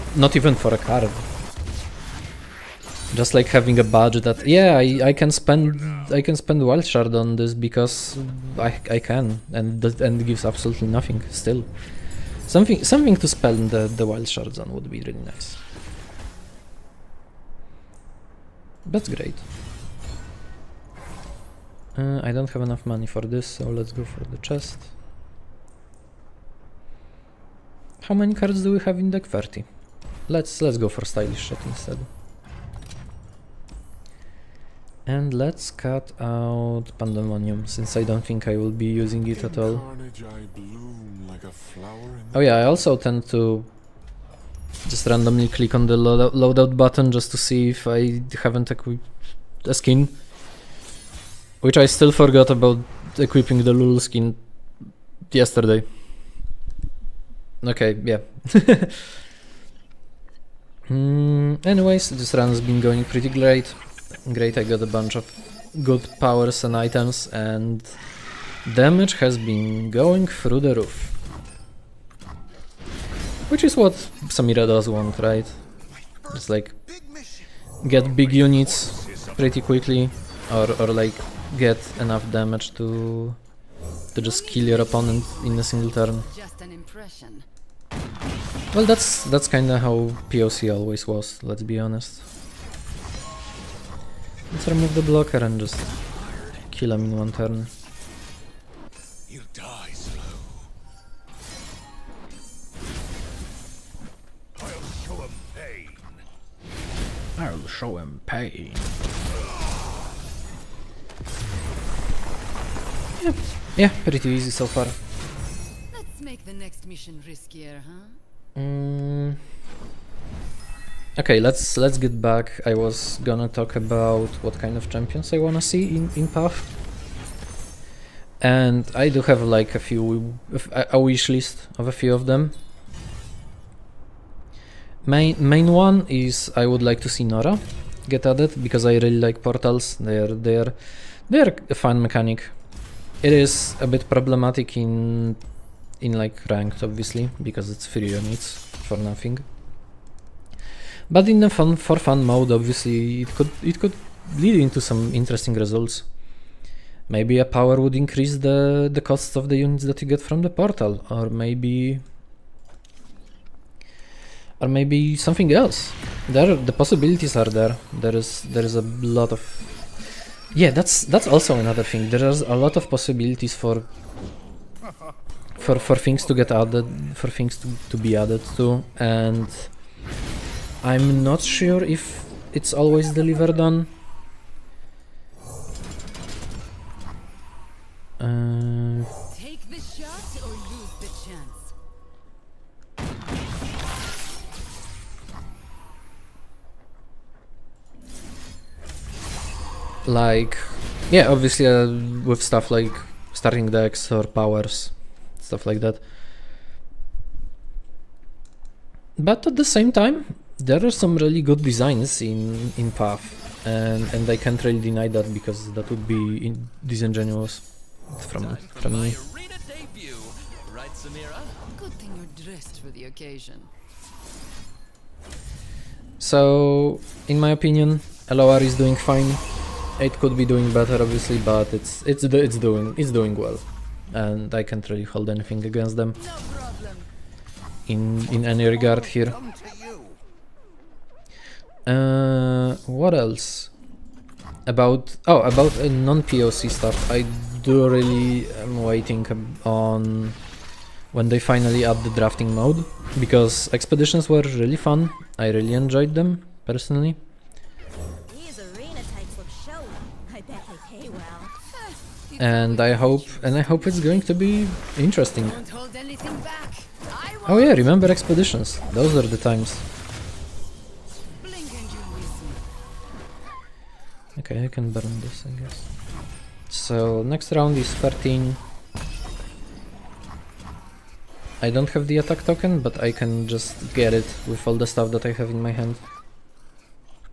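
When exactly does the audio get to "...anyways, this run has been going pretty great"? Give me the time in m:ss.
1:01.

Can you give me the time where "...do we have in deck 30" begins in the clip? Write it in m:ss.
0:28.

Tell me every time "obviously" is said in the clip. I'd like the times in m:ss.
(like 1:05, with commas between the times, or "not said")
2:26, 2:32, 3:21, 3:51.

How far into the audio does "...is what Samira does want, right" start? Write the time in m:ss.
1:13.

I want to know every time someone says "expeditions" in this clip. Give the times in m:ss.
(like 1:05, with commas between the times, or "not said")
4:13, 4:28.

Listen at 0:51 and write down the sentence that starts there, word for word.
Which I still forgot about equipping the Lul skin yesterday.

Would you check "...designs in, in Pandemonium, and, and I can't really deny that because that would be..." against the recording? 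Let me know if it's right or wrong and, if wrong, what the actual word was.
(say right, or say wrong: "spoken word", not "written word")
wrong: "Path", not "Pandemonium".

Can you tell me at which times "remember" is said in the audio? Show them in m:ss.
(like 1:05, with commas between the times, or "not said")
4:27.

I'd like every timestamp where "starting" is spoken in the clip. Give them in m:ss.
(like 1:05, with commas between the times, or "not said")
3:23.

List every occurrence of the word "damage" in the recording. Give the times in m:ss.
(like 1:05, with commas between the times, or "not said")
1:08, 1:22.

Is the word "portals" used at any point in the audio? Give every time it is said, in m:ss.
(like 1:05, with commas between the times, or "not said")
2:19, 2:40.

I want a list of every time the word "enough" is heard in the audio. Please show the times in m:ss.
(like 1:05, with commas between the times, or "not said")
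0:22, 1:21.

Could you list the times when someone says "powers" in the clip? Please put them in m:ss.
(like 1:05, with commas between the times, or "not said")
1:06, 2:37, 3:24.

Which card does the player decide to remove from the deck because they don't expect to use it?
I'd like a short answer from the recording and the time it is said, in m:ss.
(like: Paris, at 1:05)
Pandemonium, at 0:36.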